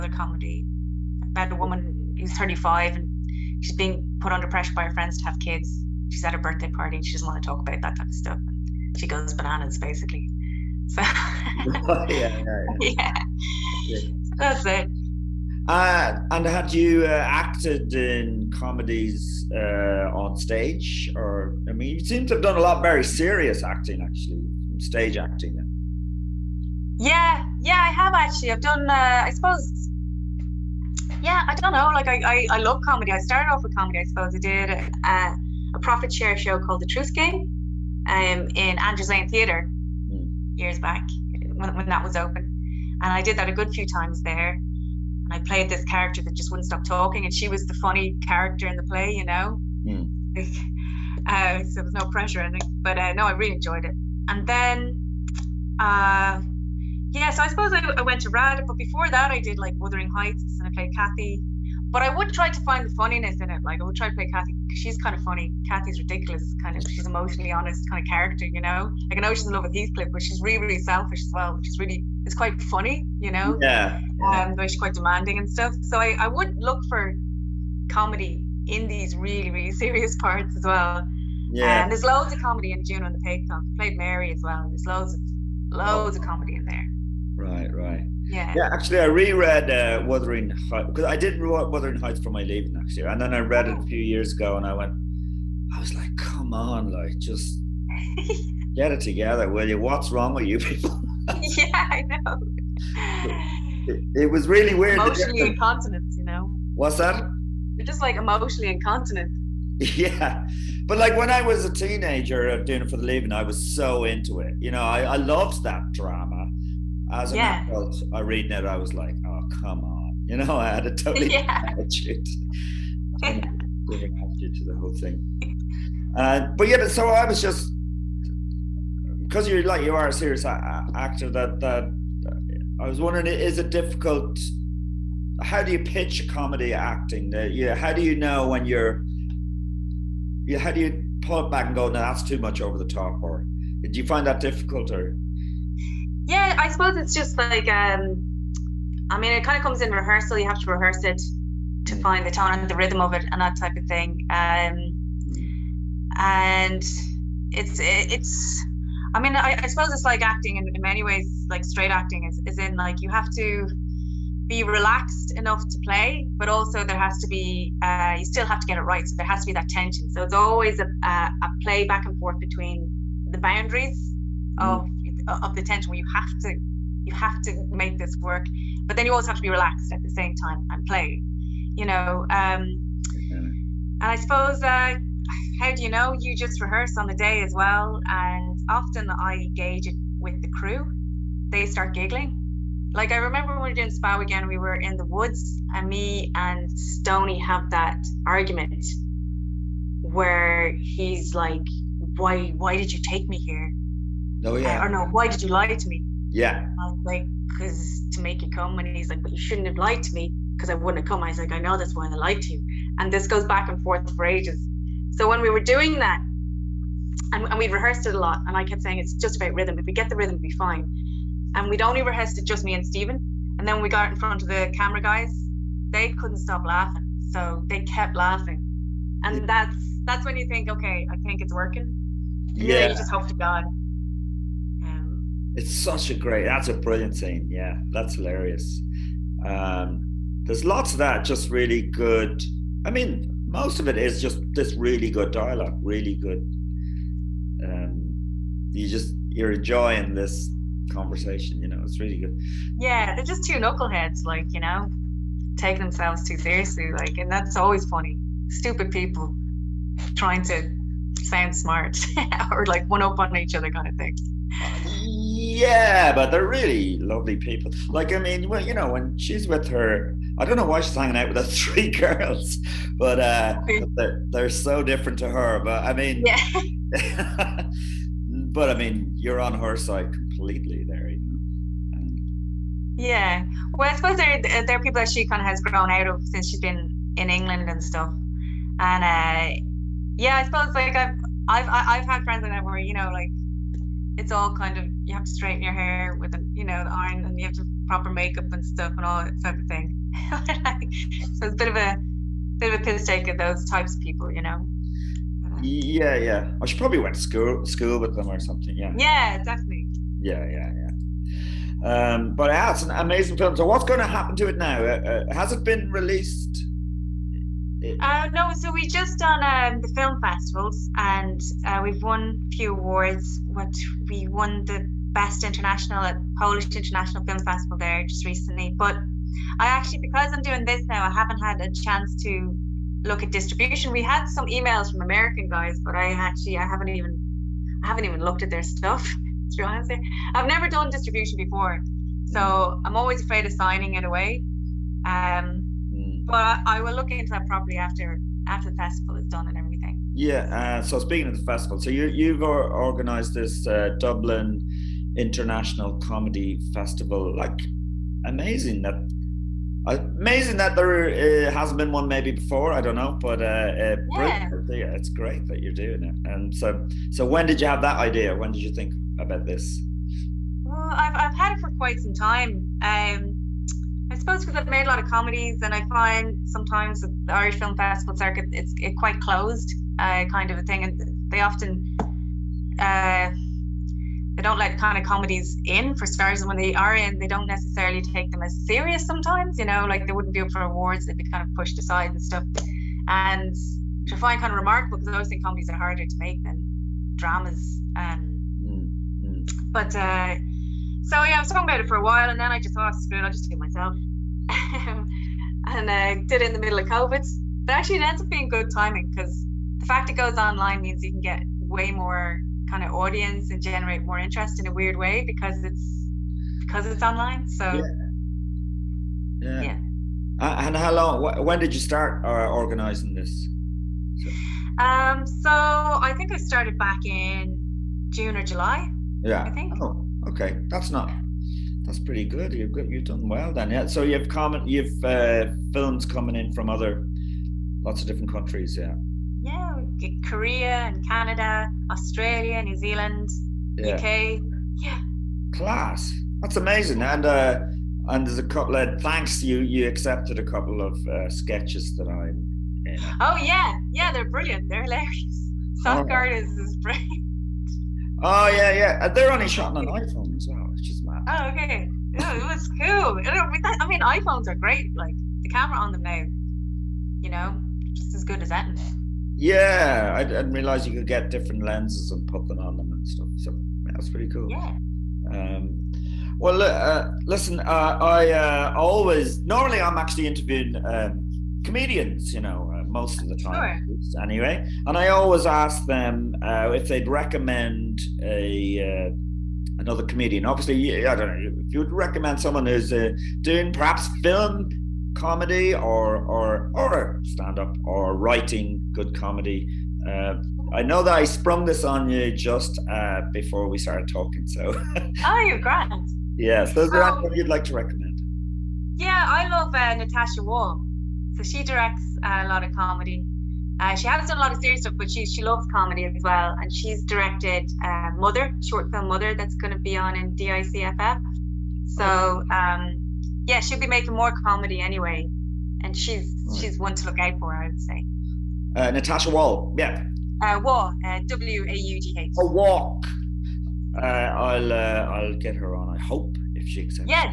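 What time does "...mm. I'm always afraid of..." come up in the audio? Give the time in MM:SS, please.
05:42.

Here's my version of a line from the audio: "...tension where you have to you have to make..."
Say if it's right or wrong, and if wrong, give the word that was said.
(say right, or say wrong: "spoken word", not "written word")
right.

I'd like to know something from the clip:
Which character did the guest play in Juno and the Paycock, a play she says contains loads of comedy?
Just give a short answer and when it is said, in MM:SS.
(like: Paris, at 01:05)
Mary, at 01:23.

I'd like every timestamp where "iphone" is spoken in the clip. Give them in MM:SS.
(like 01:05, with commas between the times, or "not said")
07:39, 07:44.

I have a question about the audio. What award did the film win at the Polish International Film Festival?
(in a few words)
Best international.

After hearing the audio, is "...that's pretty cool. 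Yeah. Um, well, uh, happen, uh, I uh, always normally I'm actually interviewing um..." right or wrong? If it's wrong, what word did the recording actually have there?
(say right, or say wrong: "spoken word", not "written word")
wrong: "listen", not "happen".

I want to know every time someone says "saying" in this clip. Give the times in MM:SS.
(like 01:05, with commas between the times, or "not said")
03:38.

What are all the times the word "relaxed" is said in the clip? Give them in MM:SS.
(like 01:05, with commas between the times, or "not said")
02:44, 02:59.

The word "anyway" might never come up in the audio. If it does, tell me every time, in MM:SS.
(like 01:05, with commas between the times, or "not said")
08:04, 08:44.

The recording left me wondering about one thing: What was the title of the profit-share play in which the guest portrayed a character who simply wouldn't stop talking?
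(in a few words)
The Truth Game.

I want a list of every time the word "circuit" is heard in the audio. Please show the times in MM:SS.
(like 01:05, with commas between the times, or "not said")
06:18.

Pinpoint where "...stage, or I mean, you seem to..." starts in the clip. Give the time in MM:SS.
00:20.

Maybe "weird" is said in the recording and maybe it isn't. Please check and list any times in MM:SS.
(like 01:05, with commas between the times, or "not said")
01:44, 06:54.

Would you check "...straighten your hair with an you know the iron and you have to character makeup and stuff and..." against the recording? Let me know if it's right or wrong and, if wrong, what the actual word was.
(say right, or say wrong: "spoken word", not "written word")
wrong: "proper", not "character".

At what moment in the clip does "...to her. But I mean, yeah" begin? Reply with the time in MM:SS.
04:35.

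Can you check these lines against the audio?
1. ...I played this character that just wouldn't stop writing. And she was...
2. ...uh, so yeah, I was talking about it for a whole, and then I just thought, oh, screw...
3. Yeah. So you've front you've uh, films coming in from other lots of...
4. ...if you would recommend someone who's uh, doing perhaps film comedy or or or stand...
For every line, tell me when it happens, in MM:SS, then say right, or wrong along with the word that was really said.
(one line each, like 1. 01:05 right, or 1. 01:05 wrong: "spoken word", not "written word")
1. 00:45 wrong: "talking", not "writing"
2. 06:39 wrong: "while", not "whole"
3. 07:13 wrong: "comment", not "front"
4. 08:11 right.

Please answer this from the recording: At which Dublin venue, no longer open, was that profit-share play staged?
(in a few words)
Andrews Lane Theatre.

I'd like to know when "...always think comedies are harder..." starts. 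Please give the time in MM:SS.
06:35.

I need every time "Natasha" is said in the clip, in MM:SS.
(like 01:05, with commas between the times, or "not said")
08:29, 08:48.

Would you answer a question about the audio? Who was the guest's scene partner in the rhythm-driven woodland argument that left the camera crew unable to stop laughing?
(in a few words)
Steven.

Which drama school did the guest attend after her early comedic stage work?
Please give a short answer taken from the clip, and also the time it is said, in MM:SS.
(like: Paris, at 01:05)
RAD, at 00:58.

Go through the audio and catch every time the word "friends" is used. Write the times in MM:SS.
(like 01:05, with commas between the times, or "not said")
00:04, 04:52.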